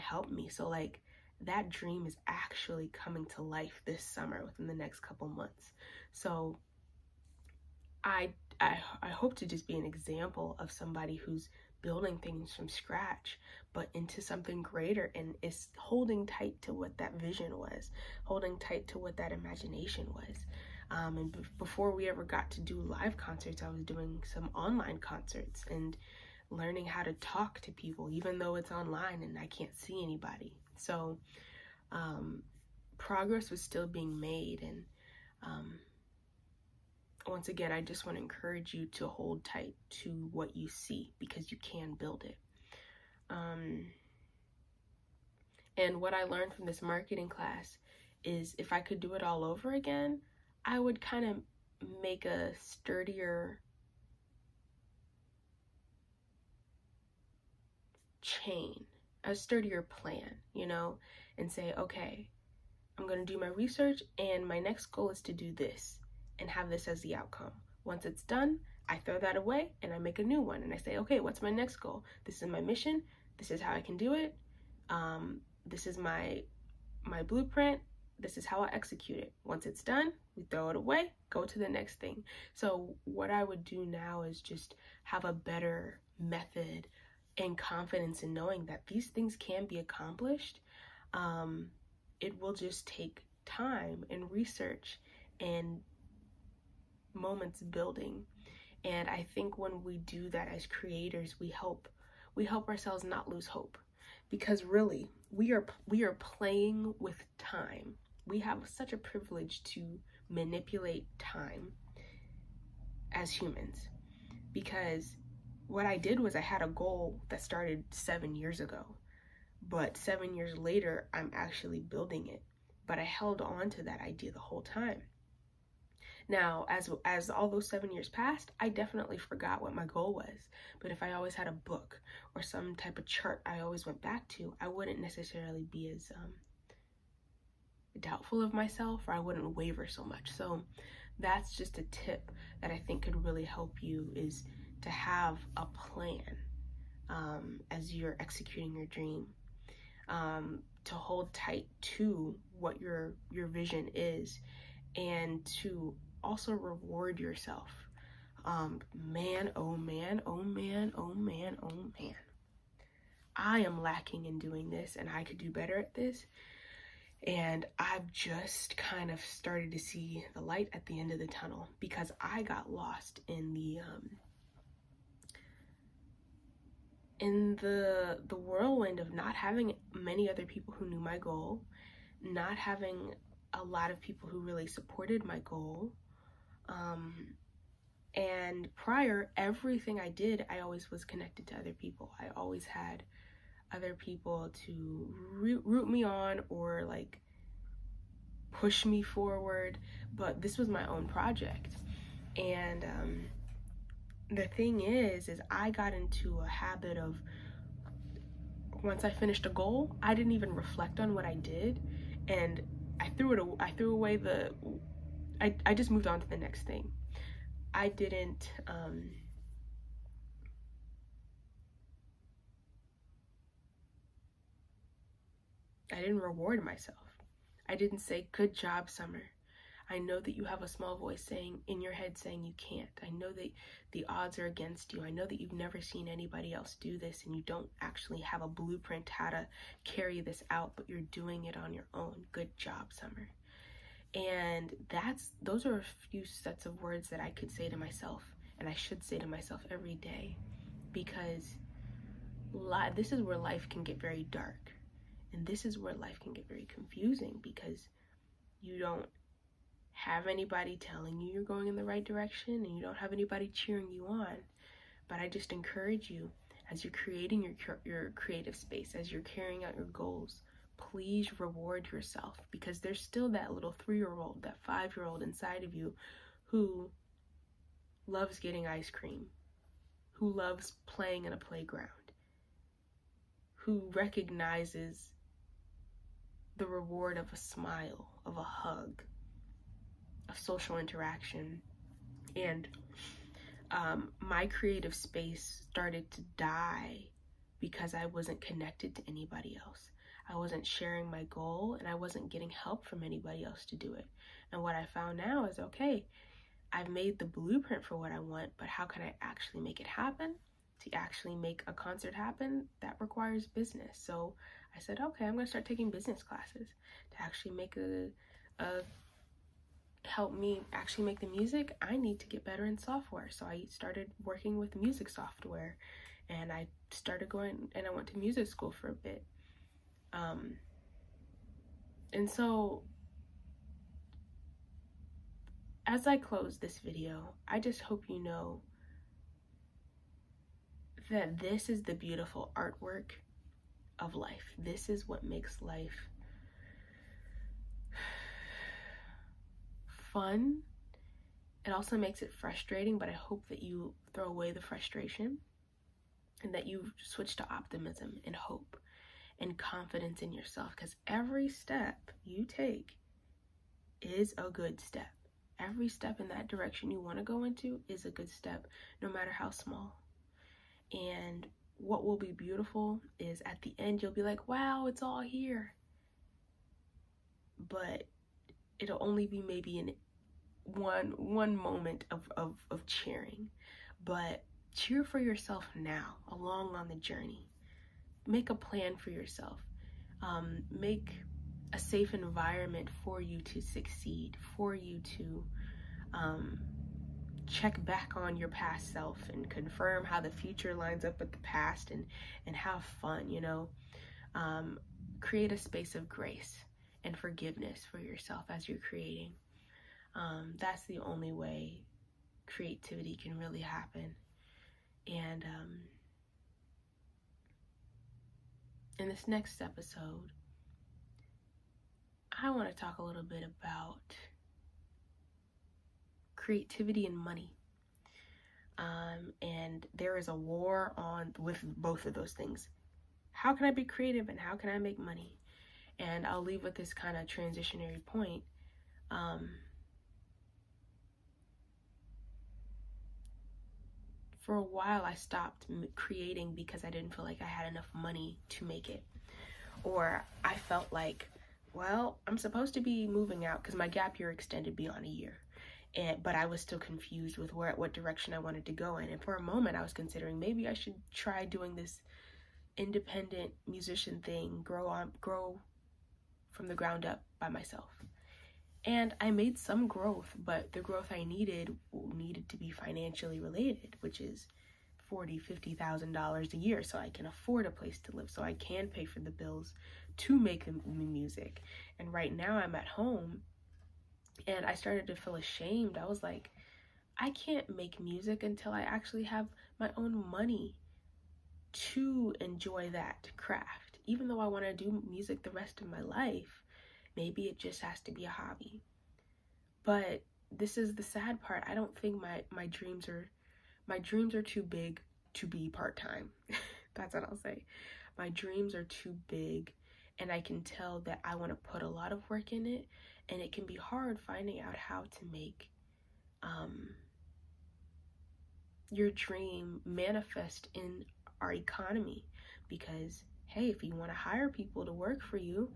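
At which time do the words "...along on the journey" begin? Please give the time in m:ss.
6:26.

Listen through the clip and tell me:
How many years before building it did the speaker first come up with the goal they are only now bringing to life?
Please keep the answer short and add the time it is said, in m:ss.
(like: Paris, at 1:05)
7, at 1:57.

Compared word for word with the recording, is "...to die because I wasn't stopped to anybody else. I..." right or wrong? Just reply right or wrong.
wrong.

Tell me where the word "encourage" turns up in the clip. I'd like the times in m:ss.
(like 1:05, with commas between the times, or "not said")
0:38, 4:25.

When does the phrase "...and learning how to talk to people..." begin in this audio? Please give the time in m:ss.
0:25.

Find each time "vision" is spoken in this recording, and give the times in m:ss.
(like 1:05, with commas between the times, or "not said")
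0:17, 2:33.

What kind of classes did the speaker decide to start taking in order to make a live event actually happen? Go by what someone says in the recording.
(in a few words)
Business classes.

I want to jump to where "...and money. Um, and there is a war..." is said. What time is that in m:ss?
7:07.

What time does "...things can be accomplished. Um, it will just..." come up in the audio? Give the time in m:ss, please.
1:29.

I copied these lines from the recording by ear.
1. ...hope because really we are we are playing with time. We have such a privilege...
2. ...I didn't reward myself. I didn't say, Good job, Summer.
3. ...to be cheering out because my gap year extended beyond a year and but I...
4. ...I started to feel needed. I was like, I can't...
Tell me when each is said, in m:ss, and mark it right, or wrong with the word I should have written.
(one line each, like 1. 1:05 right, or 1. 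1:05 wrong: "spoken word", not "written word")
1. 1:43 right
2. 3:45 right
3. 7:32 wrong: "moving", not "cheering"
4. 8:04 wrong: "ashamed", not "needed".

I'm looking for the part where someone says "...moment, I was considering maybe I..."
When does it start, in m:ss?
7:39.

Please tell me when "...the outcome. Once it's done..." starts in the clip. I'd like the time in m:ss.
1:07.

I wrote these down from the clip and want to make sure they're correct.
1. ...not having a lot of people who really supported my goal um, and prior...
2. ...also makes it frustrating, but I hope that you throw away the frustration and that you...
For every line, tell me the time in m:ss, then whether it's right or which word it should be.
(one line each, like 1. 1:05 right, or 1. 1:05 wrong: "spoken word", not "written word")
1. 3:02 right
2. 5:51 right.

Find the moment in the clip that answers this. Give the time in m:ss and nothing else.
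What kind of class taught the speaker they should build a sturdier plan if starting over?
0:46.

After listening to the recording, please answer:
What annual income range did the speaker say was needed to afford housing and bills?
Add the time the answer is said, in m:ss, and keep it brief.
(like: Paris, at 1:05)
$40,000-$50,000, at 7:55.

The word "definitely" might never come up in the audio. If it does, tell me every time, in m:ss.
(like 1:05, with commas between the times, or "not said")
2:08.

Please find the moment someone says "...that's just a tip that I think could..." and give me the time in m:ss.
2:21.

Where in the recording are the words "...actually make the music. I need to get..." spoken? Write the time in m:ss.
5:20.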